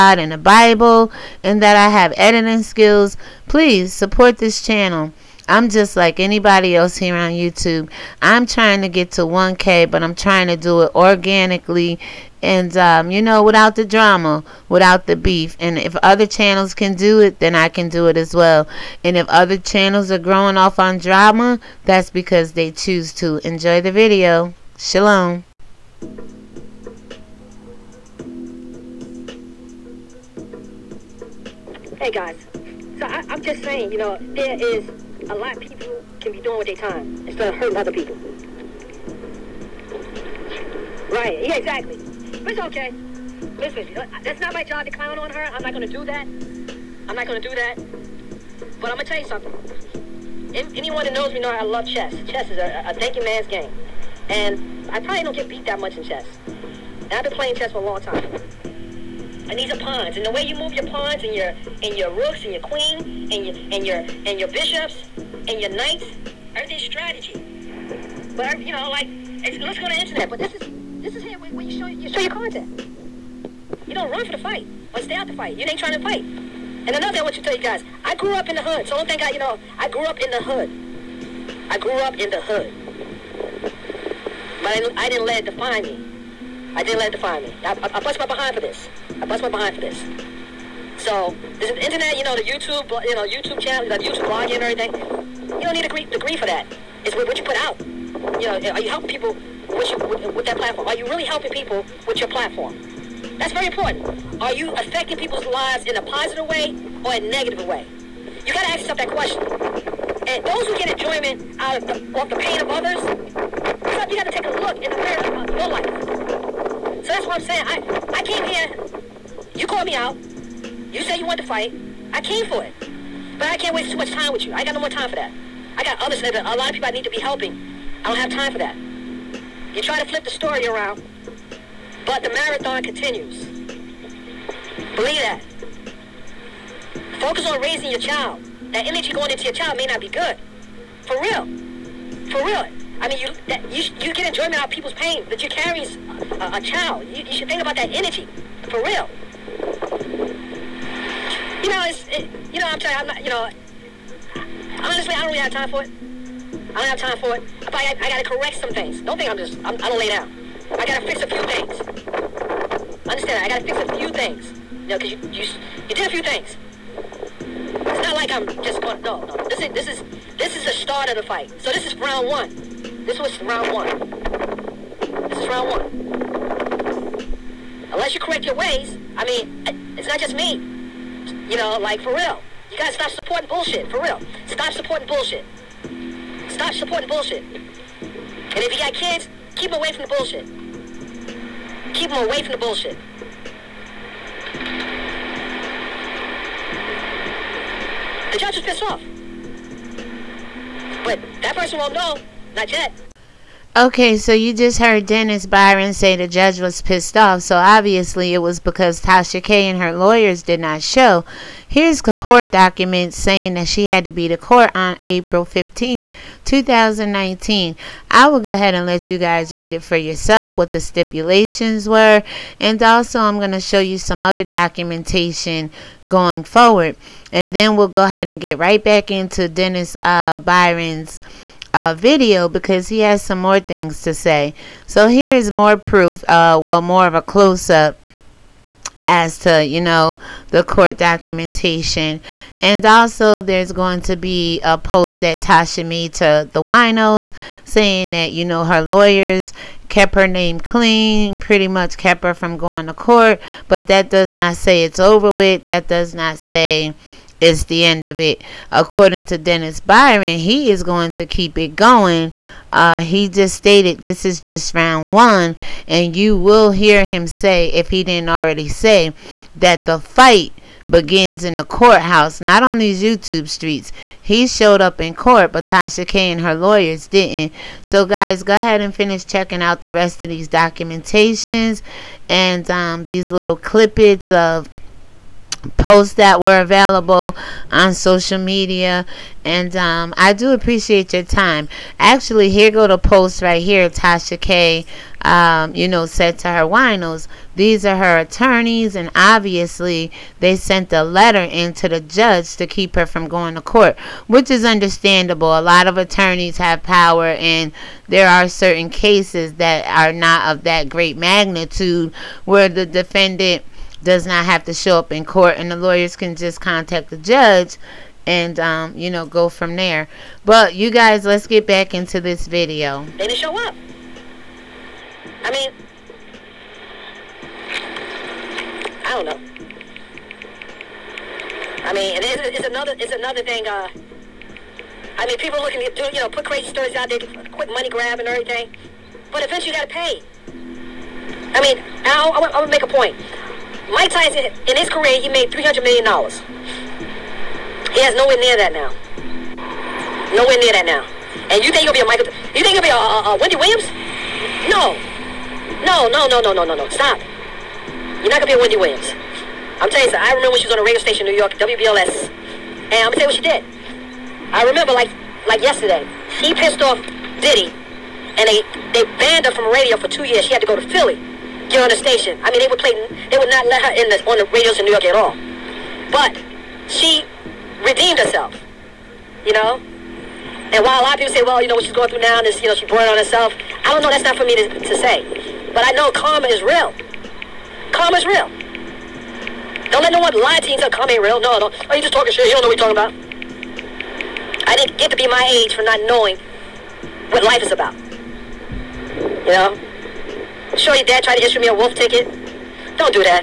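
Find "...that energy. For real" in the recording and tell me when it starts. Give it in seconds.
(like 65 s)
147 s.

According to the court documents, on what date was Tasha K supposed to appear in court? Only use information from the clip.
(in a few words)
April 15th, 2019.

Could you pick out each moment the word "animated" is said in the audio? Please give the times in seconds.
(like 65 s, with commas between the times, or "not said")
not said.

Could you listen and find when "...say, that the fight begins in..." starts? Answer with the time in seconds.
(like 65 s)
268 s.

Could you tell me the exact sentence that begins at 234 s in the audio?
So here is more proof, uh, well, more of a close up as to, you know, the court documentation.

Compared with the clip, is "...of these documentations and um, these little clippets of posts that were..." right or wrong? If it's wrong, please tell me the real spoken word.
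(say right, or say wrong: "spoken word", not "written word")
right.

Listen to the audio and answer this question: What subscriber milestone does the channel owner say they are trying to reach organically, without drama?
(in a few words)
1K.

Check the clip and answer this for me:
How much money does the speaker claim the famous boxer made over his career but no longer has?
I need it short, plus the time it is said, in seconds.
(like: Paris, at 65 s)
$300 million, at 345 s.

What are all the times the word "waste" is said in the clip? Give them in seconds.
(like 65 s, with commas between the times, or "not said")
123 s.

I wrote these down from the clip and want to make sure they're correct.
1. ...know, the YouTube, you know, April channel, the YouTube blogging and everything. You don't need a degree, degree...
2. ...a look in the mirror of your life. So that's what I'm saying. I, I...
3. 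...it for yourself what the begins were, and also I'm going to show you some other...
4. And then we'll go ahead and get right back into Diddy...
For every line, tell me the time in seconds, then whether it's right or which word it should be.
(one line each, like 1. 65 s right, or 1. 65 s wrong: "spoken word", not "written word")
1. 92 s wrong: "YouTube", not "April"
2. 114 s right
3. 219 s wrong: "stipulations", not "begins"
4. 227 s wrong: "Dennis", not "Diddy".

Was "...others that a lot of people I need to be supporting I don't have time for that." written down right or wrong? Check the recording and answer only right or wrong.
wrong.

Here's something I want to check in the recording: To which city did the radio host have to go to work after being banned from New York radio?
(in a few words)
Philly.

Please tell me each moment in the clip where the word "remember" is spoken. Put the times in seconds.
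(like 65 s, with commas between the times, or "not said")
360 s, 364 s.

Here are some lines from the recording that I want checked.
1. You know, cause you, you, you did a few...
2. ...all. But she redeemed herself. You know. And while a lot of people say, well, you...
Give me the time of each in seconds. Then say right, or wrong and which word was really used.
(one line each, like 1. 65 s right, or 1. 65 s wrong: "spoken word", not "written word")
1. 164 s right
2. 375 s right.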